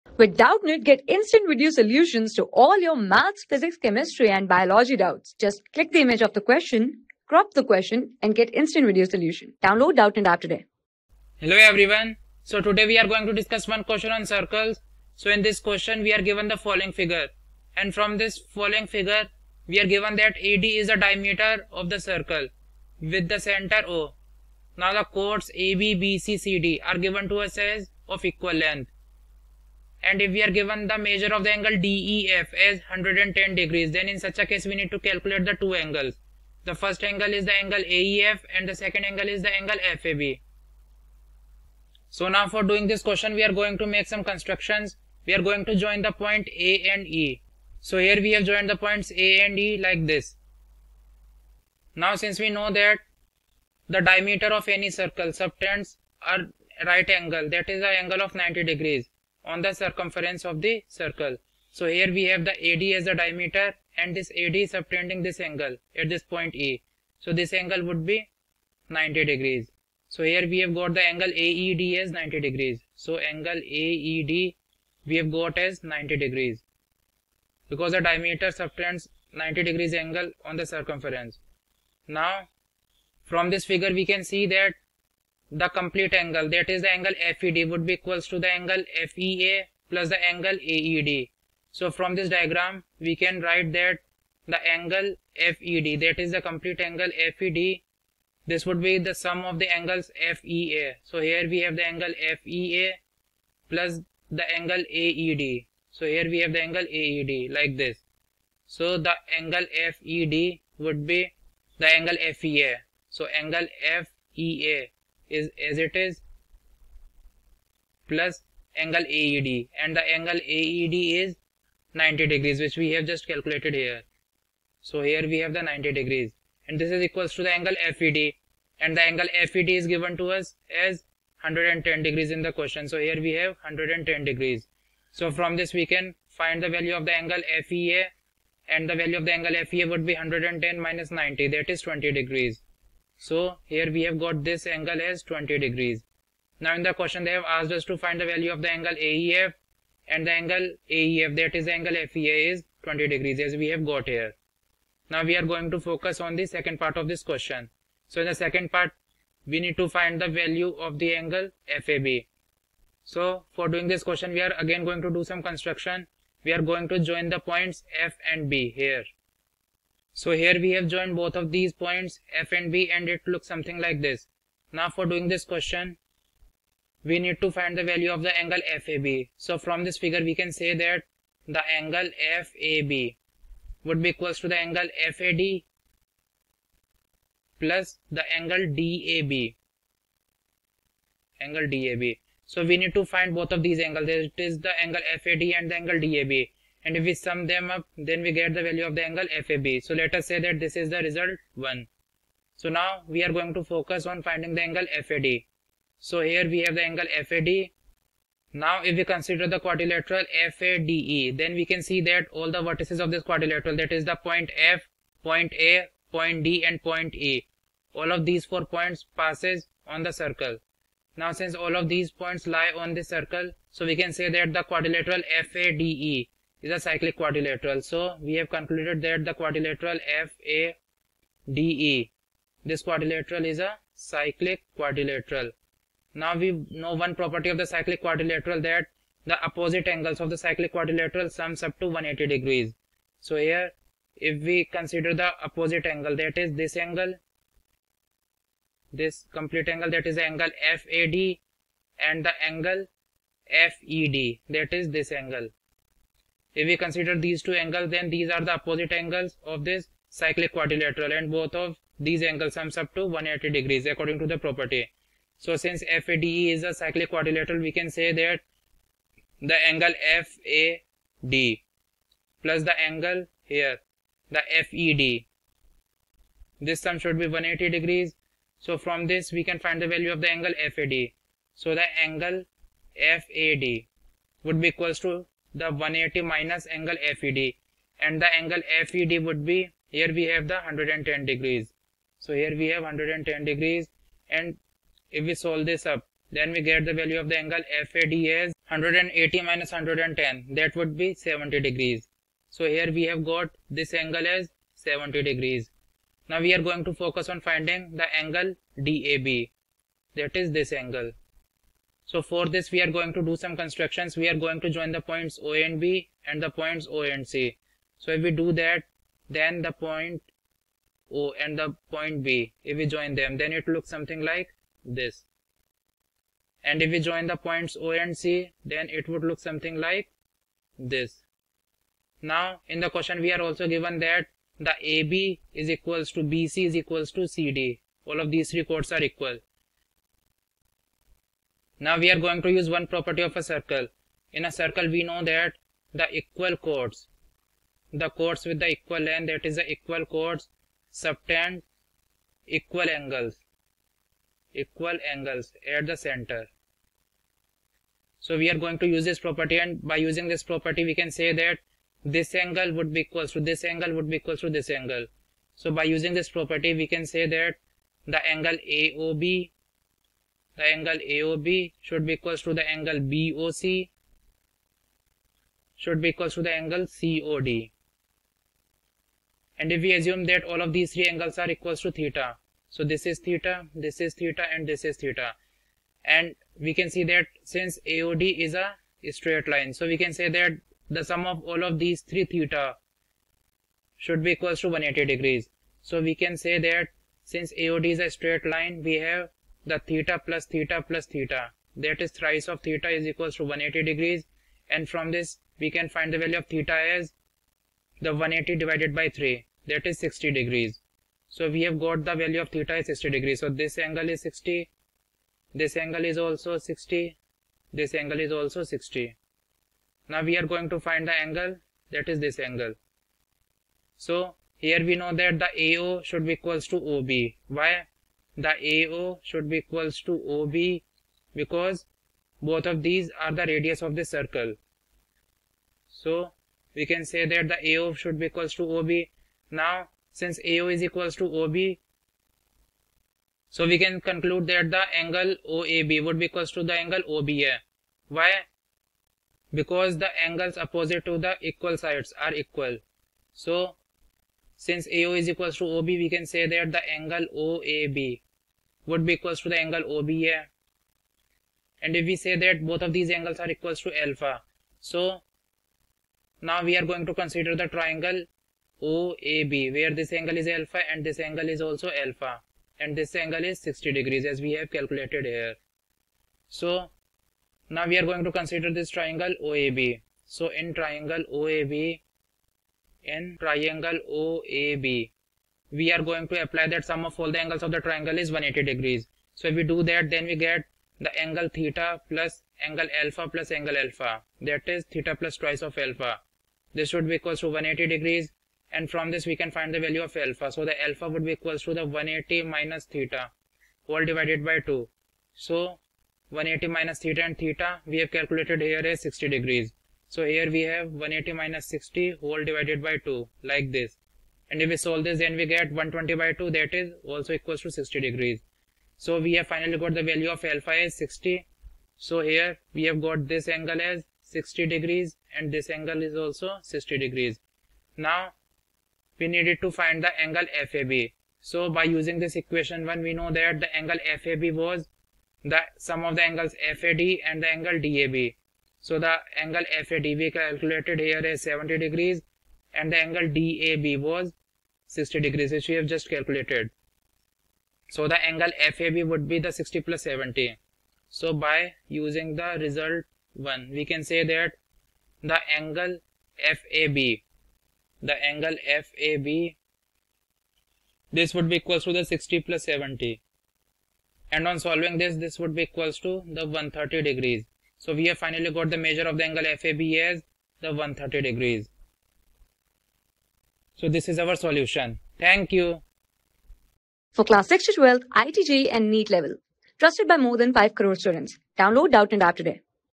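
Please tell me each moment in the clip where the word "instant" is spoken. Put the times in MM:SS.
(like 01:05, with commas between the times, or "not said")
00:01, 00:08.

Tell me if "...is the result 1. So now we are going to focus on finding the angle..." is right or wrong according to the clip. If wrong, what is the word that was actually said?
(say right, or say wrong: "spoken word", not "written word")
right.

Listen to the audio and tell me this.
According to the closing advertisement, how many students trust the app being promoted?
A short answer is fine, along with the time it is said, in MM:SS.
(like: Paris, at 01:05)
more than 5 crore, at 09:40.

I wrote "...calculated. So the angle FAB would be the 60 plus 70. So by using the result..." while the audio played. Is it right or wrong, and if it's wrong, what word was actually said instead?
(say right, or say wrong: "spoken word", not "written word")
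right.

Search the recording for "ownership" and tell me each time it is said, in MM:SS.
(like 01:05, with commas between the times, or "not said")
not said.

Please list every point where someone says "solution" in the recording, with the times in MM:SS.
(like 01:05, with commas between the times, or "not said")
00:01, 00:09, 09:34.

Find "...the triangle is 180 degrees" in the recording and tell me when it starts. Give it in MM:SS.
08:07.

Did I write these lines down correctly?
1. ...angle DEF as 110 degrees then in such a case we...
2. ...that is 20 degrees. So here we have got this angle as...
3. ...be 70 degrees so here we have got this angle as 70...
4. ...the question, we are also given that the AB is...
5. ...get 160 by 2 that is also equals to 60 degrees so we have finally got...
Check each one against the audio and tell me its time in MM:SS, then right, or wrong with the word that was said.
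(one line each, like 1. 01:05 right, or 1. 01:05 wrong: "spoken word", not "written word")
1. 00:31 right
2. 02:21 right
3. 05:00 right
4. 05:32 right
5. 08:35 wrong: "120", not "160".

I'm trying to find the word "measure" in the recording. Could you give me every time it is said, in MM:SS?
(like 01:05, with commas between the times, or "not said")
00:30, 09:28.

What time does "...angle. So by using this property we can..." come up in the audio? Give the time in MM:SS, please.
06:04.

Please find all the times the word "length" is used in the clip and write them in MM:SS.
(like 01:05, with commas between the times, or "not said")
00:28, 05:48.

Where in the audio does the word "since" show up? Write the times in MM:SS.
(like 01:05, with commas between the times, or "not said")
00:52, 03:41, 04:25, 06:27, 06:37, 07:20, 07:34.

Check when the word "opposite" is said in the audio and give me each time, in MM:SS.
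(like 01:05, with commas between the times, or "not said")
03:59, 04:05, 04:18, 07:30.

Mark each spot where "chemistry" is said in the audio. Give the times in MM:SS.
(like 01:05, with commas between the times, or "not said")
00:03.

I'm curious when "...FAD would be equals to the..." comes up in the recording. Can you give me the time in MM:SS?
04:42.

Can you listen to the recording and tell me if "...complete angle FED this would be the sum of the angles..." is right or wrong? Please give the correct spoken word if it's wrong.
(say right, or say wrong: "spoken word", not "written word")
right.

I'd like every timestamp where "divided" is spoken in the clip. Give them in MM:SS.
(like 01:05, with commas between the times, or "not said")
06:48, 08:24, 08:32.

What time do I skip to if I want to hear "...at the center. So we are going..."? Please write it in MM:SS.
05:55.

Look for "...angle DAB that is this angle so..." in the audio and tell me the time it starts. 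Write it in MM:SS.
05:08.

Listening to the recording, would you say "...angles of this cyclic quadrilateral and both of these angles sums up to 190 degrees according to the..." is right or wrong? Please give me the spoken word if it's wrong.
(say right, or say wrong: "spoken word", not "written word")
wrong: "180", not "190".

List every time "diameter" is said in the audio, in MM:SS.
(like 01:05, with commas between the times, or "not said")
00:20, 00:54, 01:03, 01:18.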